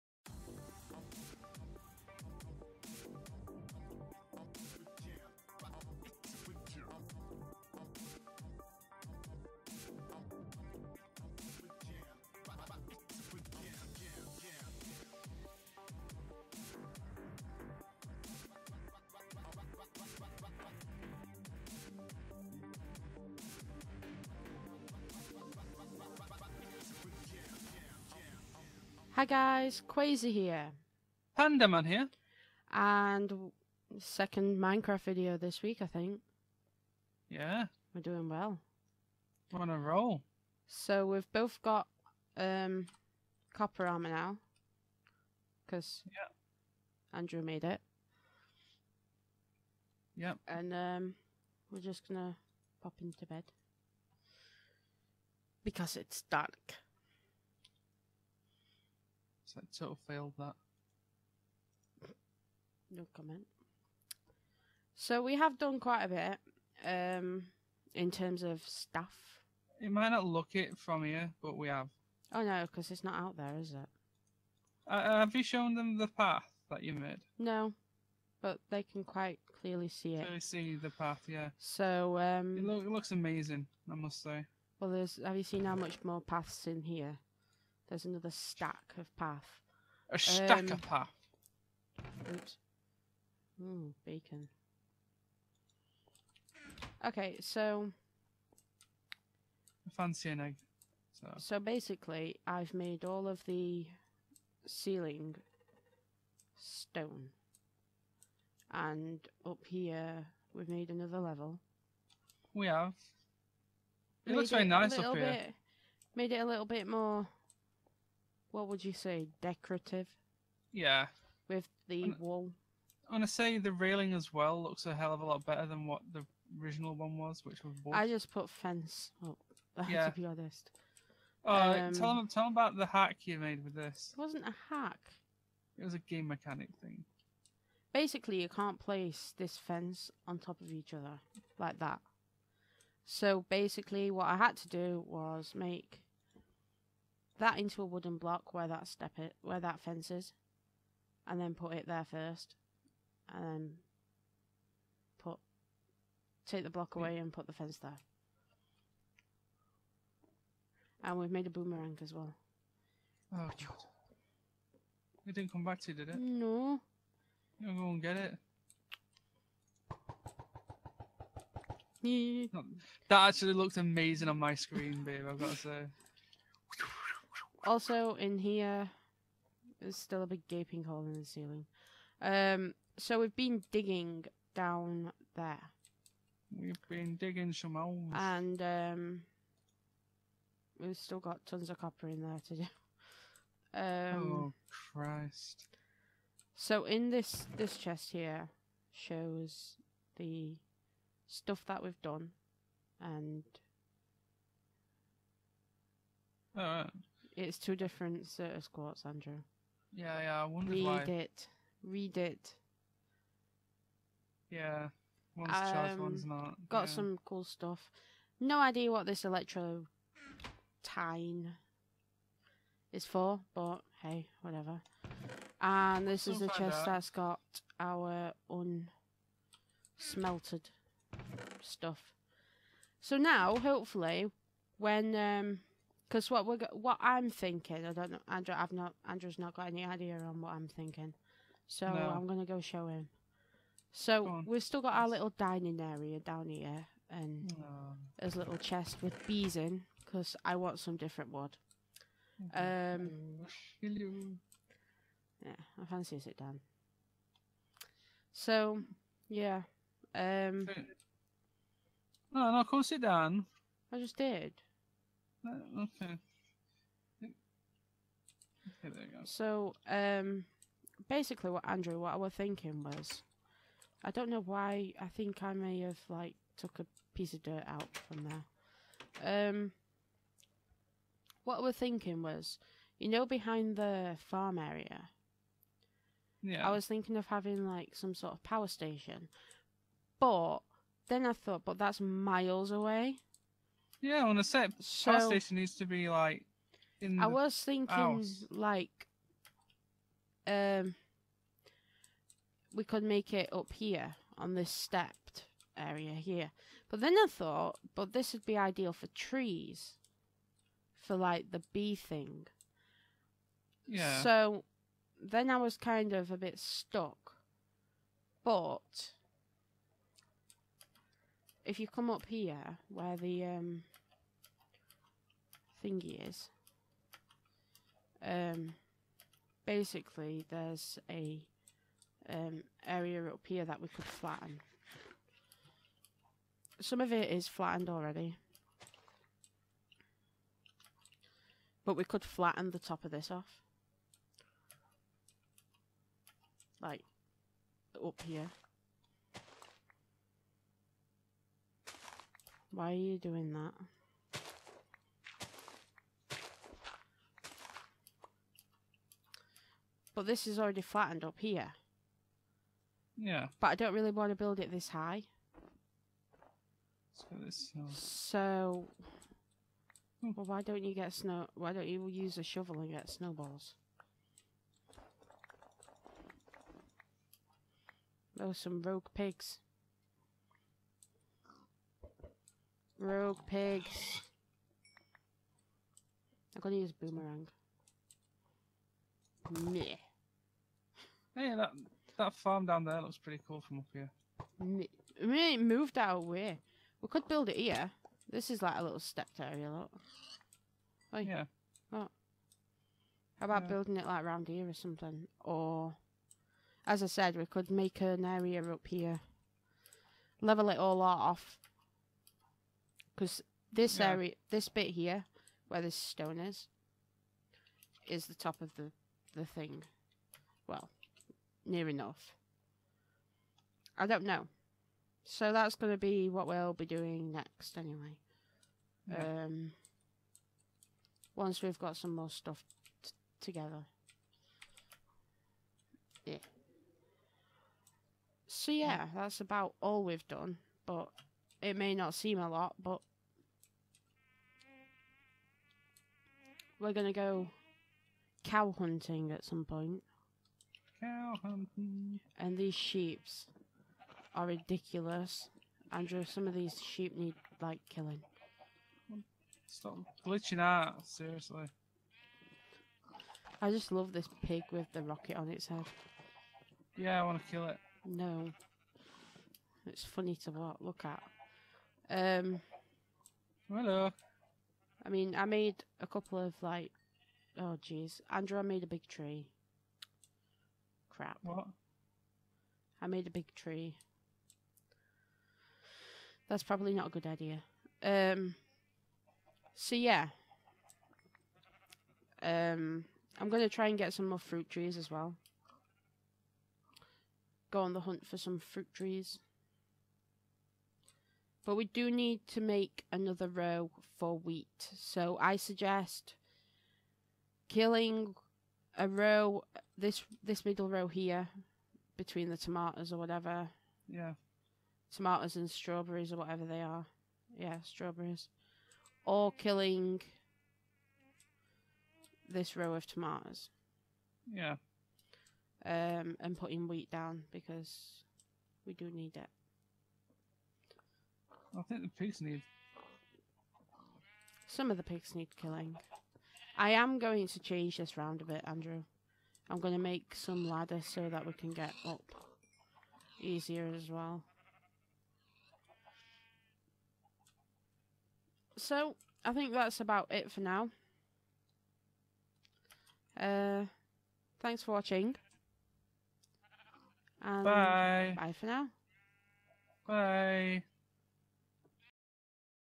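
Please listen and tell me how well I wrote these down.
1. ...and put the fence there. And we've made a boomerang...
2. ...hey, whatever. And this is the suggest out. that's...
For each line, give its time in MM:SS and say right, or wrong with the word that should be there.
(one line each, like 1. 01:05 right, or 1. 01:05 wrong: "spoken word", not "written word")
1. 02:37 right
2. 03:44 wrong: "chest", not "suggest".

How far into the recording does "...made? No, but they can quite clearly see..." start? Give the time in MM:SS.
01:16.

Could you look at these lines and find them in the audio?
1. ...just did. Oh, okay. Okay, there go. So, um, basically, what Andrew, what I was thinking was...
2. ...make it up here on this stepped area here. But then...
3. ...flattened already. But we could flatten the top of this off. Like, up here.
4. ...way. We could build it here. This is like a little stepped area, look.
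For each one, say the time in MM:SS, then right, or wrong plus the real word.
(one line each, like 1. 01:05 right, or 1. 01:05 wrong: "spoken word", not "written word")
1. 04:23 right
2. 05:03 right
3. 05:37 right
4. 06:36 right.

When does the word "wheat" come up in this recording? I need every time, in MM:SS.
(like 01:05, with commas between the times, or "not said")
08:24, 08:46.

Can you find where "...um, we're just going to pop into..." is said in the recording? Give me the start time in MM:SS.
00:50.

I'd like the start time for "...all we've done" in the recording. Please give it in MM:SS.
07:19.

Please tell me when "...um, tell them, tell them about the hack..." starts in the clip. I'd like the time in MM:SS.
02:11.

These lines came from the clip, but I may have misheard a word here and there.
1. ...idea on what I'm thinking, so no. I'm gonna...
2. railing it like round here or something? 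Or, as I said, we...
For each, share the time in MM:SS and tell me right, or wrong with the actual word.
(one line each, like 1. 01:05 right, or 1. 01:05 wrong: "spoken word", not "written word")
1. 03:59 right
2. 06:43 wrong: "building", not "railing".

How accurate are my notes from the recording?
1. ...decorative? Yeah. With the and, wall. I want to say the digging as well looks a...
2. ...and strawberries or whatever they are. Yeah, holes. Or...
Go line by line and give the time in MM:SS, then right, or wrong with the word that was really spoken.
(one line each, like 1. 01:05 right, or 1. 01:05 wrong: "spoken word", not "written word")
1. 01:59 wrong: "railing", not "digging"
2. 08:35 wrong: "strawberries", not "holes".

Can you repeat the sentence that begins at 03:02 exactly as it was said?
Um, so we've been digging down there.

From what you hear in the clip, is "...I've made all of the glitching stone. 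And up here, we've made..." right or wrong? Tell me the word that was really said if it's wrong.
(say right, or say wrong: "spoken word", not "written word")
wrong: "ceiling", not "glitching".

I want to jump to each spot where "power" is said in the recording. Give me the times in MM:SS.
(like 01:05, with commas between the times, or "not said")
04:48, 04:55.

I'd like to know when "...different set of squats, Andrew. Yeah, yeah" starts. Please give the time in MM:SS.
03:27.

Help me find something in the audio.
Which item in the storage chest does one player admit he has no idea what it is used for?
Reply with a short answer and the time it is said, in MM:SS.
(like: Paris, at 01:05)
Electro tine, at 03:39.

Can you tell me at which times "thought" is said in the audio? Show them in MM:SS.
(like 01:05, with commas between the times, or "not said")
04:51, 05:07.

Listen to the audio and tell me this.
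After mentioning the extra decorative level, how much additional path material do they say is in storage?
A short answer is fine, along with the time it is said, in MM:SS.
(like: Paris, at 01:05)
A stack, at 01:28.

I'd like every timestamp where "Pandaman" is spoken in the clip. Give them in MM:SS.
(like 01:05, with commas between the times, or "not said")
00:31.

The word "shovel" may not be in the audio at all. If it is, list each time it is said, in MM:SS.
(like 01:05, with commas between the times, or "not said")
06:12.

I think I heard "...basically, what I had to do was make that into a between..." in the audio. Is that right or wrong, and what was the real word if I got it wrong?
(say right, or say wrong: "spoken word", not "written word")
wrong: "wooden", not "between".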